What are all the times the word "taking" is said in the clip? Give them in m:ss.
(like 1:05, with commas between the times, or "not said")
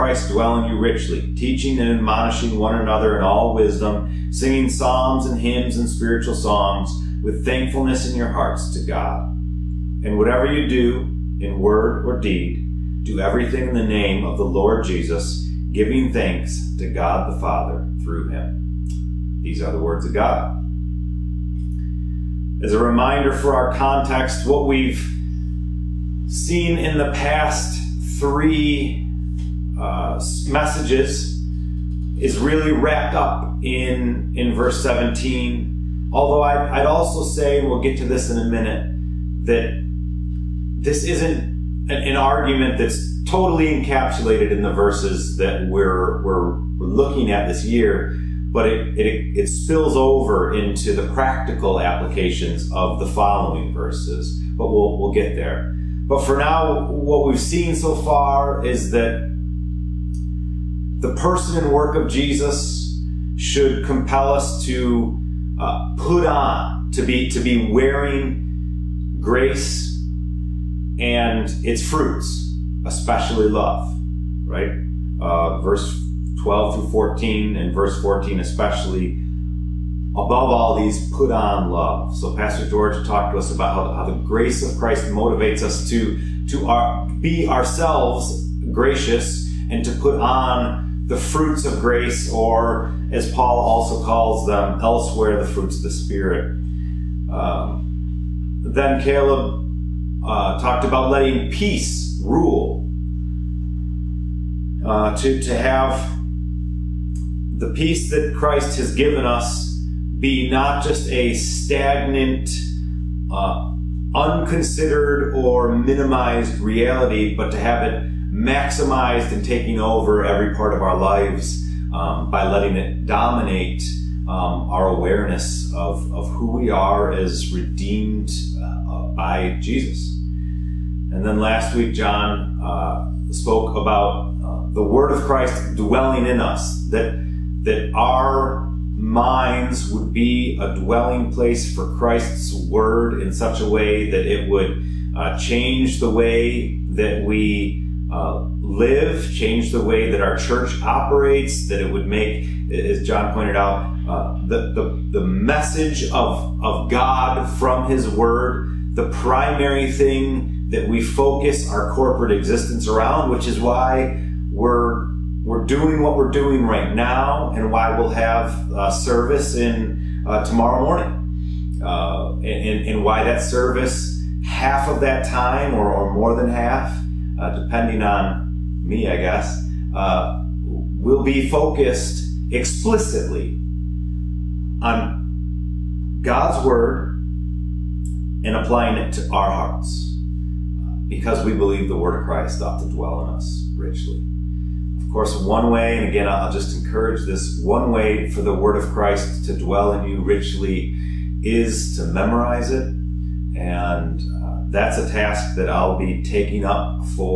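1:59, 3:26.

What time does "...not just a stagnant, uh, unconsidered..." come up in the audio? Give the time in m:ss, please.
1:50.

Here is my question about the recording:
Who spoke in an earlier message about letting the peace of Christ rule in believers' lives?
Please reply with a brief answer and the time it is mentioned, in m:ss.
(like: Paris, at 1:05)
Caleb, at 1:39.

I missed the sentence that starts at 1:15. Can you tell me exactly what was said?
Uh, verse 12 through 14 and verse 14 especially above all these, put on love.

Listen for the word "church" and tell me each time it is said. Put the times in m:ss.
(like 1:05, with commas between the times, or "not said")
2:30.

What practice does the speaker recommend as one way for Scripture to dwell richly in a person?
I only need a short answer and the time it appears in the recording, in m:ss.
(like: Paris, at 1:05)
Memorize it, at 3:22.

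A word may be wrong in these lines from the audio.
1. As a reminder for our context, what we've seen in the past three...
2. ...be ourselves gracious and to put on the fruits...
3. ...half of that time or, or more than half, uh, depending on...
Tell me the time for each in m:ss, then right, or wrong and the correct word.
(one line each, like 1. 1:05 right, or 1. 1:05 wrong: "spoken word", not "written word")
1. 0:22 right
2. 1:27 right
3. 2:54 right.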